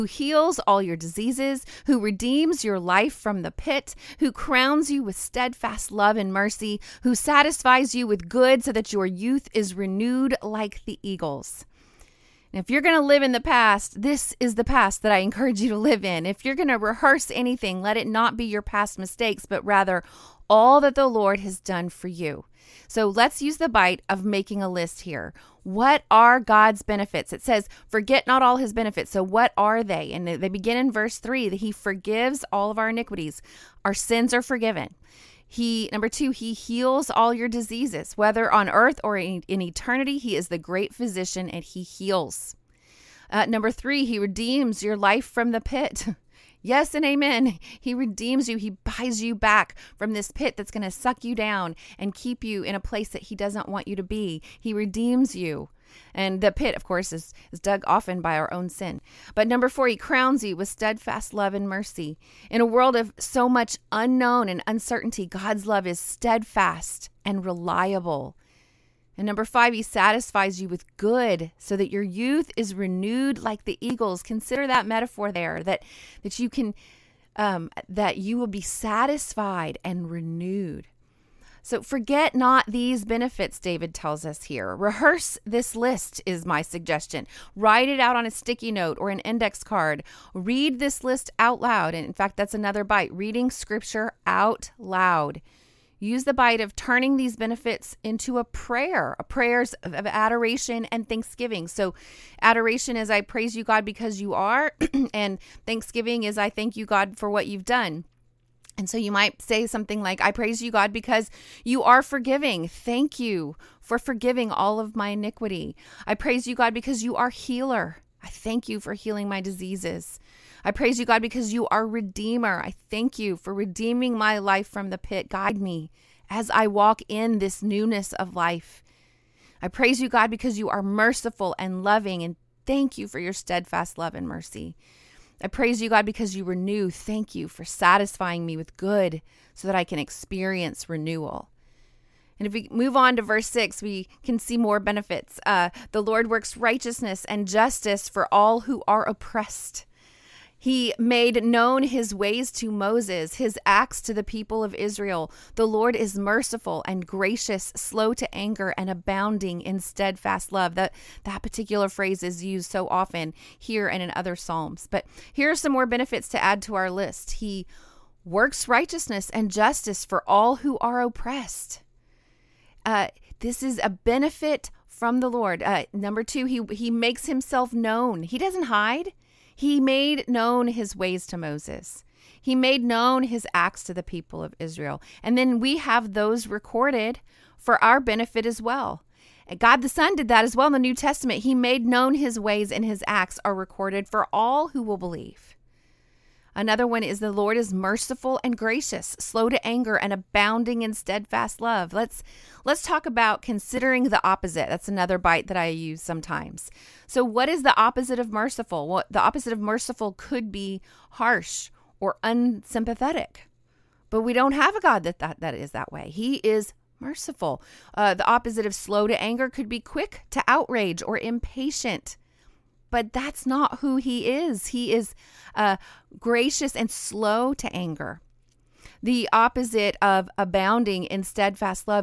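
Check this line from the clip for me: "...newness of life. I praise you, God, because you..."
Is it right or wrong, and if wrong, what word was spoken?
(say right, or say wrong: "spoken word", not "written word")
right.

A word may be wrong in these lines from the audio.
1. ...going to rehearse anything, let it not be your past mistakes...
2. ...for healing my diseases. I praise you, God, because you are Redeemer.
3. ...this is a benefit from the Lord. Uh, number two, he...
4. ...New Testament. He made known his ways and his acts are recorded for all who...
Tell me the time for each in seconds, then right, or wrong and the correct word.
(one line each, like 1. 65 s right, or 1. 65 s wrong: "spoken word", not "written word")
1. 16 s right
2. 118 s right
3. 173 s right
4. 190 s right.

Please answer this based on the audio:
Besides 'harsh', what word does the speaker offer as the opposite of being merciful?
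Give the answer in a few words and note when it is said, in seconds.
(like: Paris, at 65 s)
unsympathetic, at 212 s.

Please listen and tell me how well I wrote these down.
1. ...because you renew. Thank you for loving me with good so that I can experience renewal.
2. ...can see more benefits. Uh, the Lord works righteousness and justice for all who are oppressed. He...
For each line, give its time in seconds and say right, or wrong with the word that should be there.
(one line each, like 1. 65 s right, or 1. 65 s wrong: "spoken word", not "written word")
1. 136 s wrong: "satisfying", not "loving"
2. 144 s right.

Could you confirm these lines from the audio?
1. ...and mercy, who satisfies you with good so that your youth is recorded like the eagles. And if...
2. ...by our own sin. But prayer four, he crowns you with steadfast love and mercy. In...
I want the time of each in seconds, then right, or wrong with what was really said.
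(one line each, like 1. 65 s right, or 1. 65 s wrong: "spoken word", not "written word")
1. 6 s wrong: "renewed", not "recorded"
2. 58 s wrong: "number", not "prayer".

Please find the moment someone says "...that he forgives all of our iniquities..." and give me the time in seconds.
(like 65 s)
31 s.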